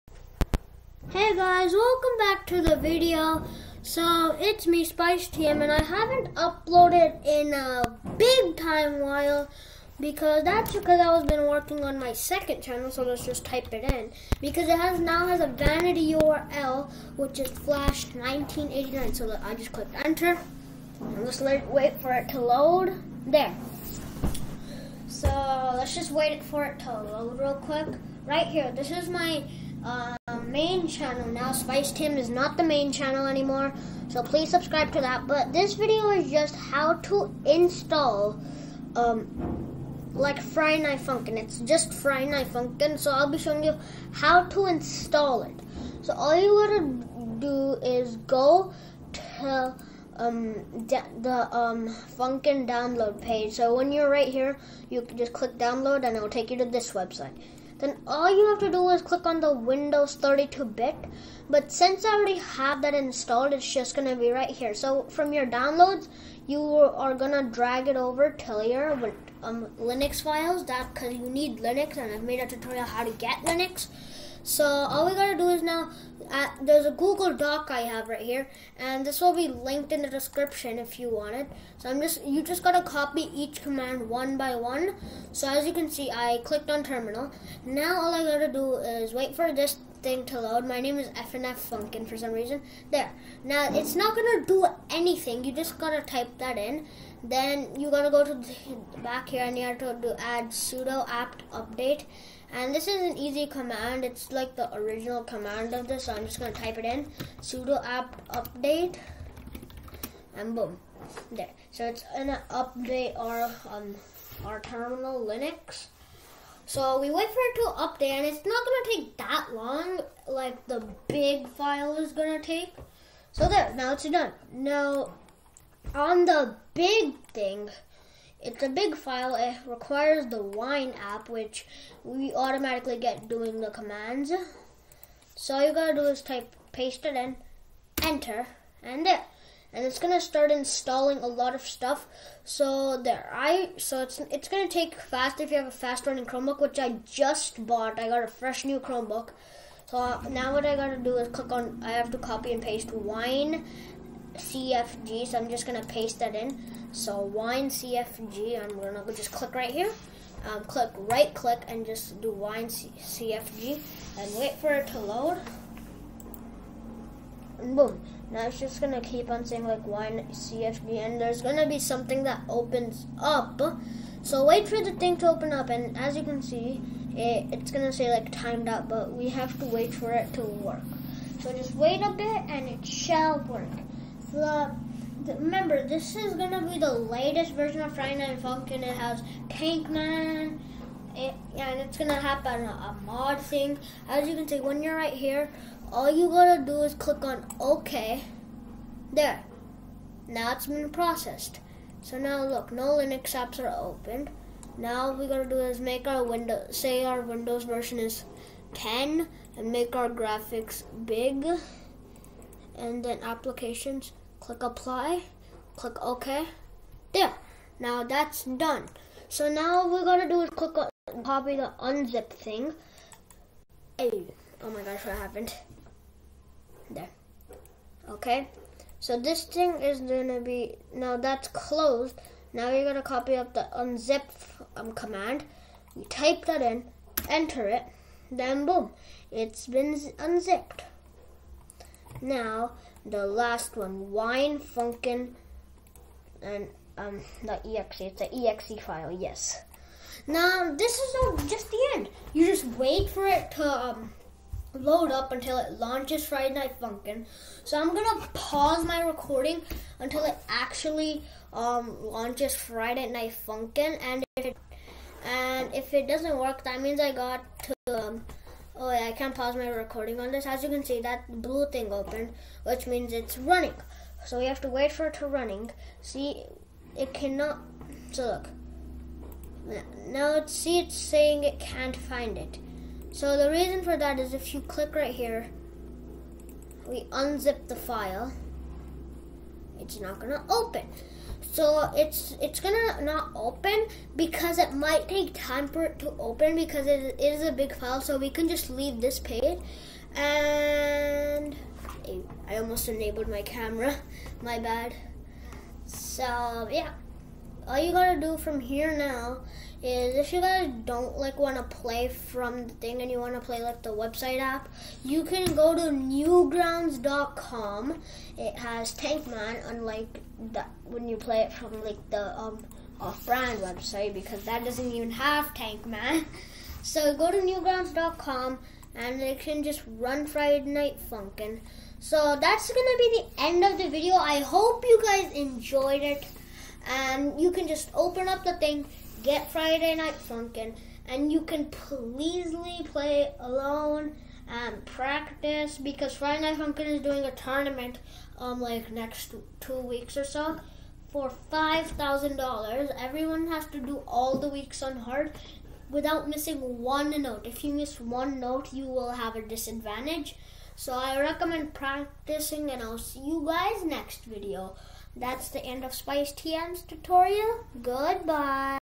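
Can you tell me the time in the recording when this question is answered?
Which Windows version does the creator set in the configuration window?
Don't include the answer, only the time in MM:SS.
03:28.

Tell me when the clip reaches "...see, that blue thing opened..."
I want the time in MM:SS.
04:30.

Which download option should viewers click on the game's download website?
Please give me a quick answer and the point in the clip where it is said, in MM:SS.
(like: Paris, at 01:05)
Windows 32-bit, at 00:59.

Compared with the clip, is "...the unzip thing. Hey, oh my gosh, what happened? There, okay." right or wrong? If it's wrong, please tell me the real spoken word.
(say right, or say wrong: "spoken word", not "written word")
right.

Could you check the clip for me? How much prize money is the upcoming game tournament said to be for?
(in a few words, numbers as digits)
$5,000.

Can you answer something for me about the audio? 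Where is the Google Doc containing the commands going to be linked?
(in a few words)
in the description.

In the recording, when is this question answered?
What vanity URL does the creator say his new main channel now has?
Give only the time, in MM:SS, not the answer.
00:17.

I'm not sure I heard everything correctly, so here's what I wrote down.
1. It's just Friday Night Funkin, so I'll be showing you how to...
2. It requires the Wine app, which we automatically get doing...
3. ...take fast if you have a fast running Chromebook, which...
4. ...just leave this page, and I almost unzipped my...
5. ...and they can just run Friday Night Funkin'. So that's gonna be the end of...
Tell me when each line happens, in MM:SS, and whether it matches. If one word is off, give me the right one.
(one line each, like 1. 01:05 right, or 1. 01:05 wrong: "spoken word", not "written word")
1. 00:41 right
2. 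02:09 right
3. 02:24 right
4. 04:58 wrong: "enabled", not "unzipped"
5. 05:28 right.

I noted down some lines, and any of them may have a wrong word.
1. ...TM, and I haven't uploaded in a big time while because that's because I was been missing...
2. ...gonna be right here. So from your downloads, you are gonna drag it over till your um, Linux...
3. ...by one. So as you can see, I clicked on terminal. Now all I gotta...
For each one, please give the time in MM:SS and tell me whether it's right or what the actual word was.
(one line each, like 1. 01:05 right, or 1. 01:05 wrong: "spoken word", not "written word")
1. 00:05 wrong: "working", not "missing"
2. 01:03 right
3. 01:24 right.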